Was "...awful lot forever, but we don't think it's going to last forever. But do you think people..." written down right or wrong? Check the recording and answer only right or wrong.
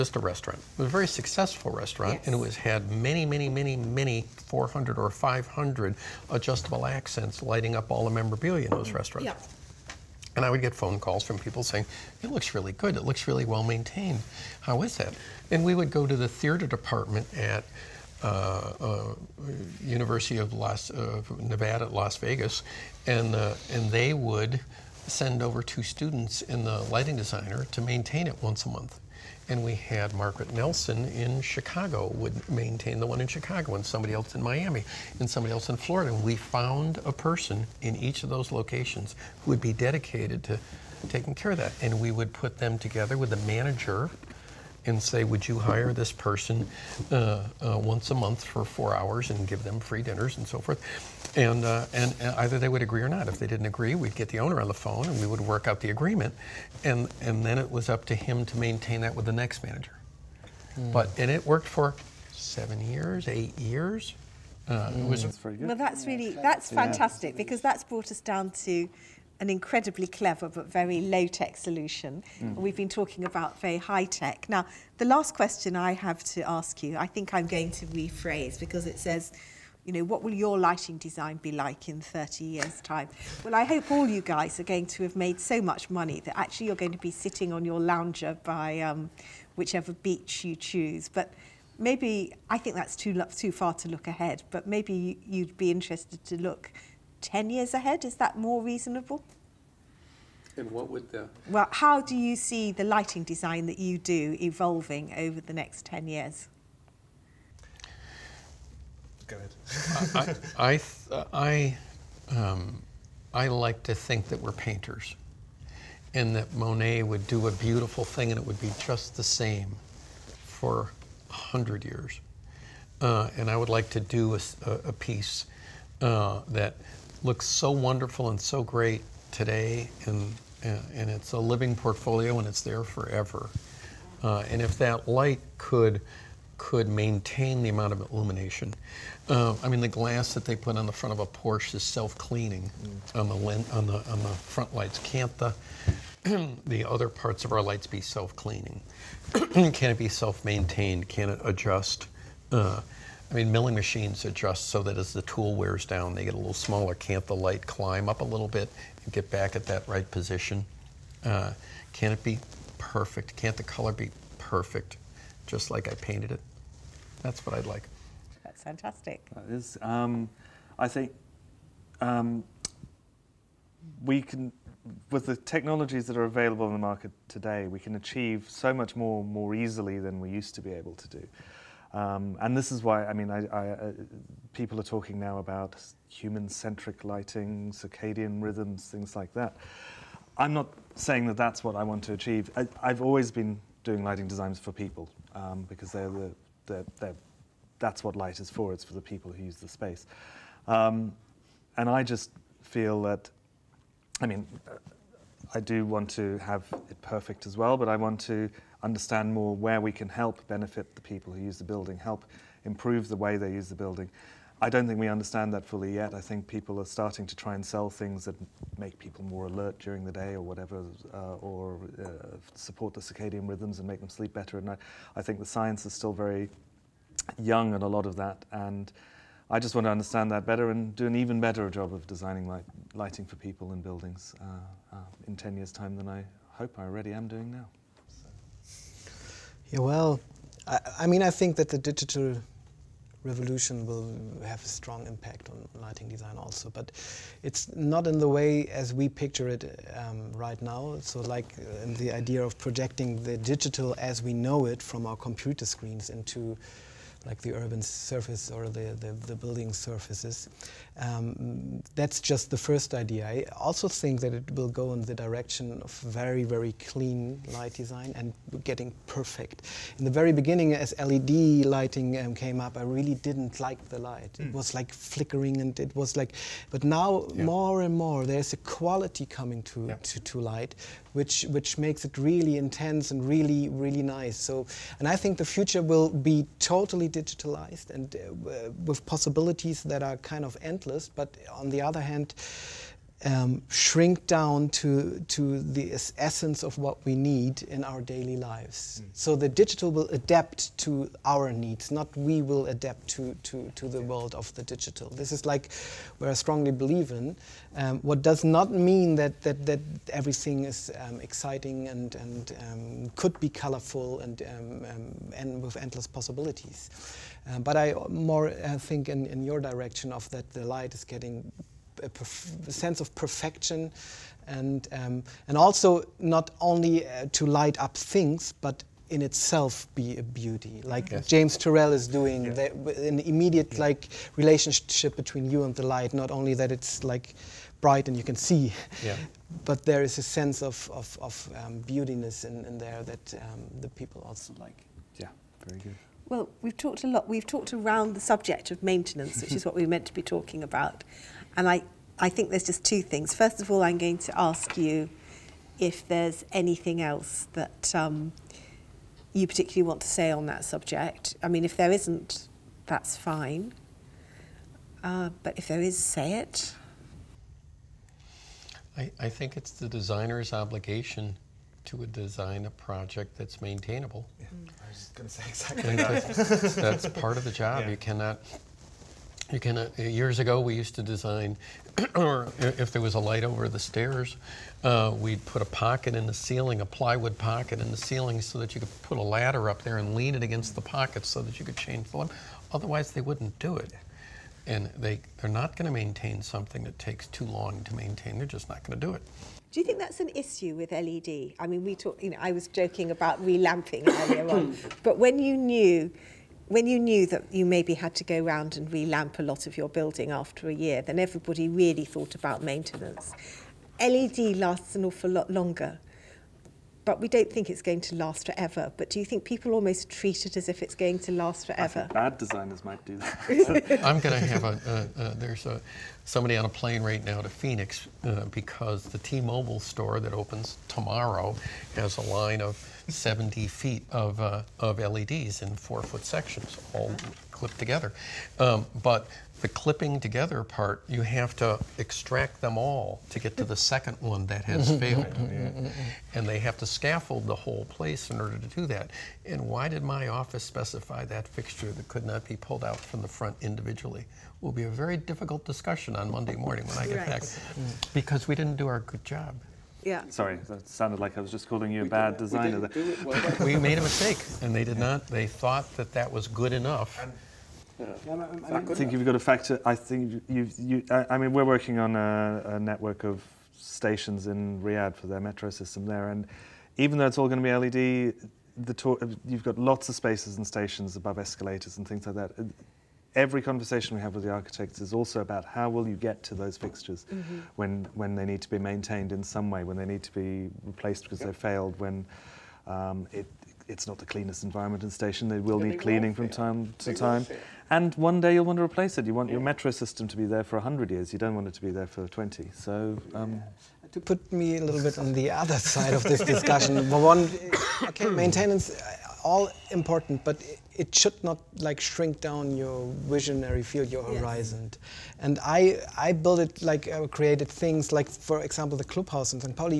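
wrong.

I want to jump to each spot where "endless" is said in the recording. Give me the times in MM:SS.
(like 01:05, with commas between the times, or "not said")
04:50, 05:15.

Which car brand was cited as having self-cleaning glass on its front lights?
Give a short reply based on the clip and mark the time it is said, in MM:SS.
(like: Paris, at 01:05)
Porsche, at 02:21.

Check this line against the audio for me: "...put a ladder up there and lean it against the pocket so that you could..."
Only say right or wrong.
right.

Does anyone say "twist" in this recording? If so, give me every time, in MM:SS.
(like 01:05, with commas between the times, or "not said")
not said.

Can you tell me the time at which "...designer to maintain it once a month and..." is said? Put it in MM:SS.
00:27.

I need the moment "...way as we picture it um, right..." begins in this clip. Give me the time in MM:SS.
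04:08.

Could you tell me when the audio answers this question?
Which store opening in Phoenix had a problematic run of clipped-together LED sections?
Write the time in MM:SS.
07:09.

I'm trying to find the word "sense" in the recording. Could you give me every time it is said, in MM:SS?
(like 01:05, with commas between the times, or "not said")
05:22, 05:40.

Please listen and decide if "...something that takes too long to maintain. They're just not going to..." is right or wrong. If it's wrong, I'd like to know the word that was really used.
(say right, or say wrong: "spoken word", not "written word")
right.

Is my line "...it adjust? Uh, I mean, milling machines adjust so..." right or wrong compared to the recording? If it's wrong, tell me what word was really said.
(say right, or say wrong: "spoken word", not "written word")
right.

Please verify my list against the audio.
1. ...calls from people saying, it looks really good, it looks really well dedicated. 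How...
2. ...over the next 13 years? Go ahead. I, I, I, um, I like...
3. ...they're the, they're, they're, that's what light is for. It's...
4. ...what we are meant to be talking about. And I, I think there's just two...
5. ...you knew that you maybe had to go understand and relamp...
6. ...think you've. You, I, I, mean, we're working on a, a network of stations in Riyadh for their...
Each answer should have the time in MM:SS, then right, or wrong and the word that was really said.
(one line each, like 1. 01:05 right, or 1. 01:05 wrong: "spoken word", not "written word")
1. 00:10 wrong: "maintained", not "dedicated"
2. 01:45 wrong: "10", not "13"
3. 03:15 right
4. 05:49 right
5. 06:46 wrong: "round", not "understand"
6. 07:49 right.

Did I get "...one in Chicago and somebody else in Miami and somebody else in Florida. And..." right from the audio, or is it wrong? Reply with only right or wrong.
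right.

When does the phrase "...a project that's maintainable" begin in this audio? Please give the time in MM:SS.
06:12.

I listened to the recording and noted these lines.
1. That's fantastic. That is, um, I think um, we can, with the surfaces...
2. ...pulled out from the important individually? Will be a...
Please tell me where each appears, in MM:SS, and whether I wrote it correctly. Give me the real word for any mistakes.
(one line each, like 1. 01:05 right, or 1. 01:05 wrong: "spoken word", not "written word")
1. 02:48 wrong: "technologies", not "surfaces"
2. 07:32 wrong: "front", not "important".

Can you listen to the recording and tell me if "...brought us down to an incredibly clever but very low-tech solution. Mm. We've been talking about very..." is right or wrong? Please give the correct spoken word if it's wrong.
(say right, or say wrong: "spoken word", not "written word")
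right.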